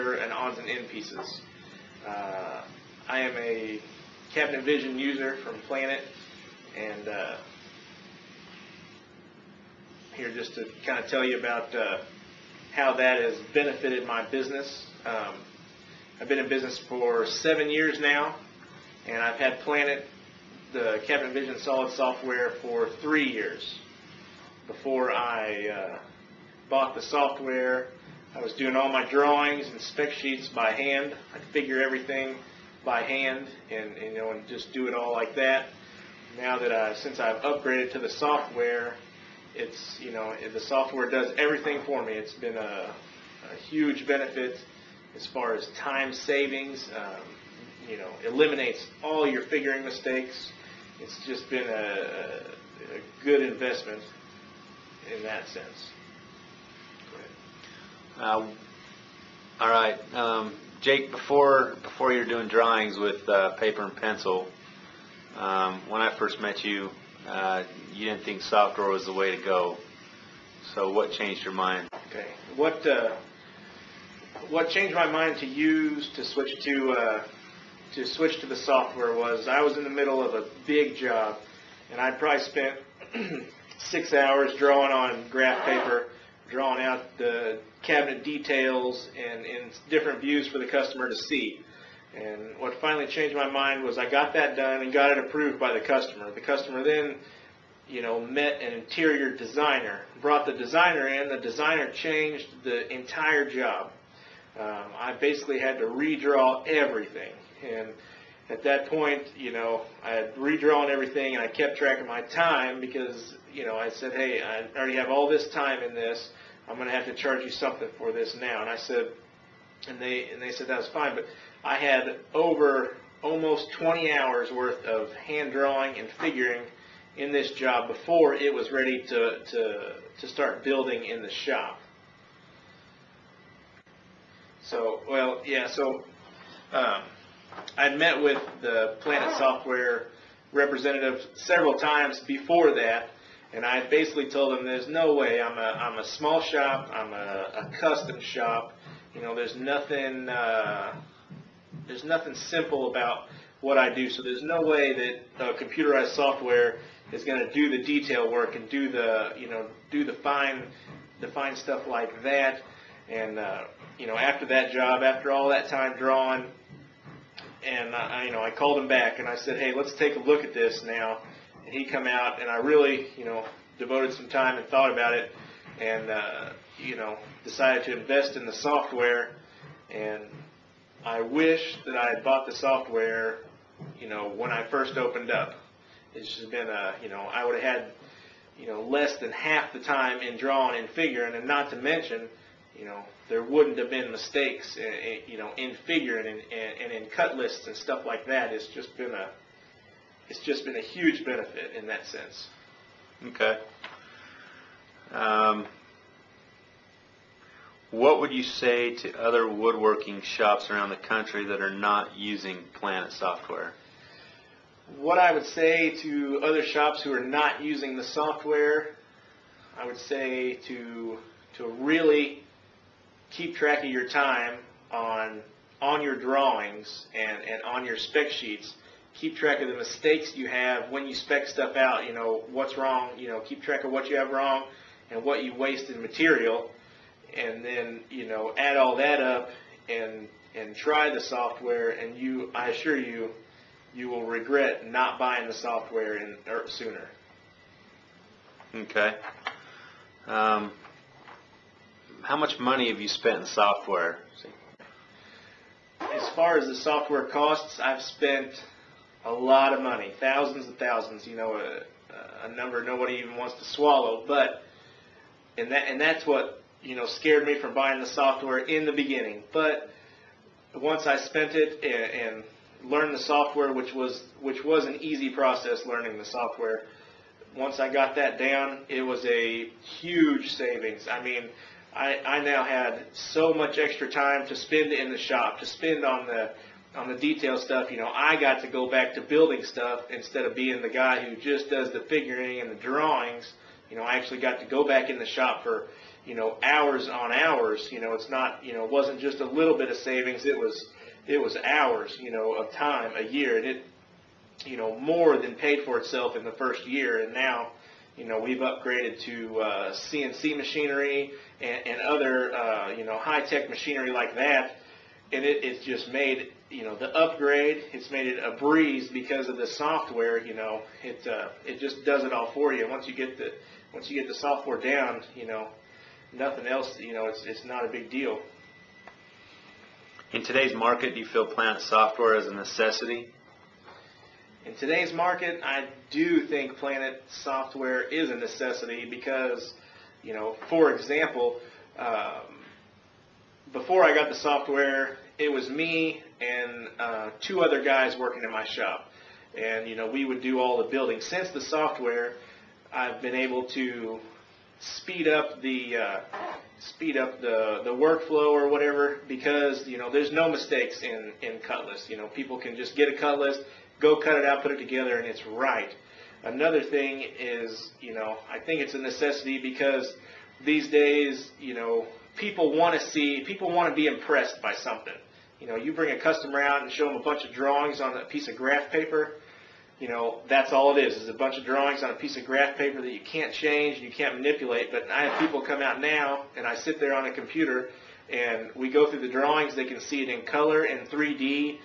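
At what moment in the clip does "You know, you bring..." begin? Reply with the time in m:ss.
6:15.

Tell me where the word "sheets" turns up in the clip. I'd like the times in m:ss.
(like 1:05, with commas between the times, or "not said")
0:30, 3:48.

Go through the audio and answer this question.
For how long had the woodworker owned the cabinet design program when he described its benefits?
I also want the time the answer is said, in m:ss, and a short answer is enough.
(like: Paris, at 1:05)
3 years, at 0:23.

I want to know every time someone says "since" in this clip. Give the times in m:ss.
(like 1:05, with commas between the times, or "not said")
0:36, 5:51.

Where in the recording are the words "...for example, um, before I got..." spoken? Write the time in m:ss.
5:40.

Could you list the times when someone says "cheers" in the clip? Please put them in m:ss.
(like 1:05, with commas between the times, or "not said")
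not said.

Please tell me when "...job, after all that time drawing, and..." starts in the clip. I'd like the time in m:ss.
2:44.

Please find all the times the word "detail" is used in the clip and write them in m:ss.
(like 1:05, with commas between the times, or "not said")
1:28, 2:37, 4:47.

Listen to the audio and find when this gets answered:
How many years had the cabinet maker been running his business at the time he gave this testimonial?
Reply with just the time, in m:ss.
0:17.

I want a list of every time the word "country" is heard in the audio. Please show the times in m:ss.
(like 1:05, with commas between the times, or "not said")
3:30.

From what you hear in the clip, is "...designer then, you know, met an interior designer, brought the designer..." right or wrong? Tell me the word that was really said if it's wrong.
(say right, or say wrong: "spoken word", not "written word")
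wrong: "customer", not "designer".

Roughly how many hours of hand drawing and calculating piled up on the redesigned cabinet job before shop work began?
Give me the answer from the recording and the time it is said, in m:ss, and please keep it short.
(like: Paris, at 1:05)
20, at 2:03.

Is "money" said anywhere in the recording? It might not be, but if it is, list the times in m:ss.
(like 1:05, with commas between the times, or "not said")
4:12, 4:19.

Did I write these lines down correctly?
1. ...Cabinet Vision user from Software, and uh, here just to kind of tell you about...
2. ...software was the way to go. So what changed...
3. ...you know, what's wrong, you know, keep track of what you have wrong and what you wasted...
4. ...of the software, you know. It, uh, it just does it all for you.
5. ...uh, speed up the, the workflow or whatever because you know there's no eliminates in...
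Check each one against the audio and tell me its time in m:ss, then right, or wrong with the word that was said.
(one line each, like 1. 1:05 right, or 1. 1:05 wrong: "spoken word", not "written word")
1. 0:04 wrong: "Planit", not "Software"
2. 1:08 right
3. 3:52 right
4. 5:19 right
5. 5:55 wrong: "mistakes", not "eliminates".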